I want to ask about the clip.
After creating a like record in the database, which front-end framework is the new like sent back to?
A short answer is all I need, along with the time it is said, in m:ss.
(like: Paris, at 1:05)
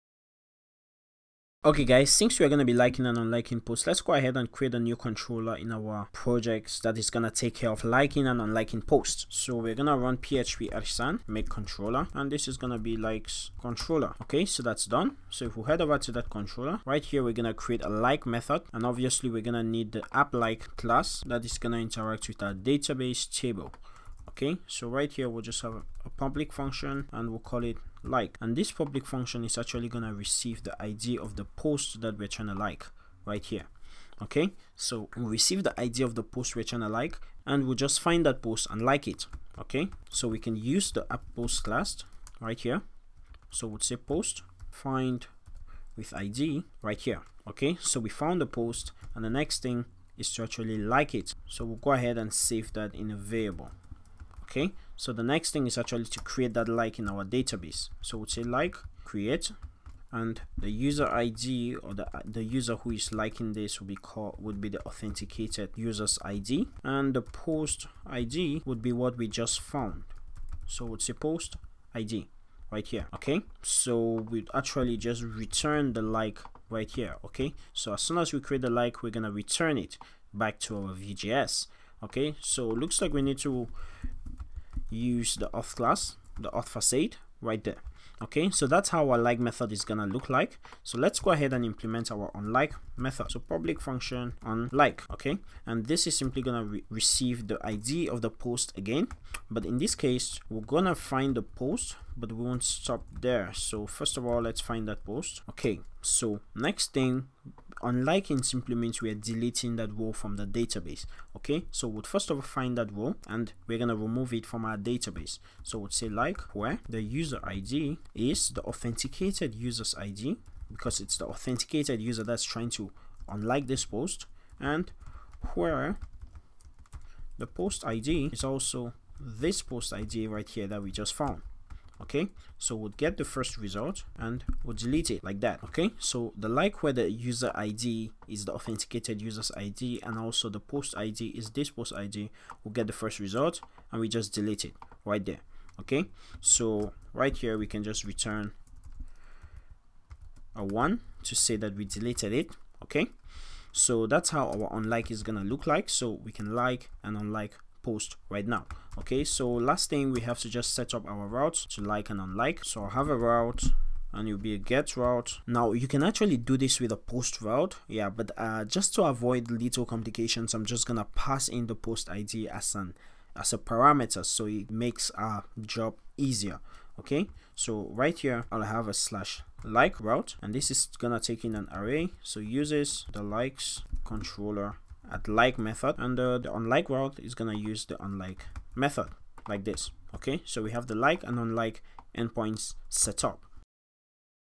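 Vue.js, at 1:20.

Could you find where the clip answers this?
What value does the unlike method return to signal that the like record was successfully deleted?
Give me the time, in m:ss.
2:30.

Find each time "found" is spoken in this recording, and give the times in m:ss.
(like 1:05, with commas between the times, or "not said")
0:48, 1:09, 2:11.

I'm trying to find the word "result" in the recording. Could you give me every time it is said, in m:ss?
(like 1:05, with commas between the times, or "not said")
2:13, 2:23.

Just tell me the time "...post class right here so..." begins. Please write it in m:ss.
0:41.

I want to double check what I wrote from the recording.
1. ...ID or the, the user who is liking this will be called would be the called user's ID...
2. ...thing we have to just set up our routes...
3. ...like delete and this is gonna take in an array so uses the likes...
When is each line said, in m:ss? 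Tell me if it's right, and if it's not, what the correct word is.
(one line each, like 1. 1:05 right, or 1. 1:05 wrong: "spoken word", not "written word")
1. 1:01 wrong: "authenticated", not "called"
2. 2:39 right
3. 2:59 wrong: "route", not "delete".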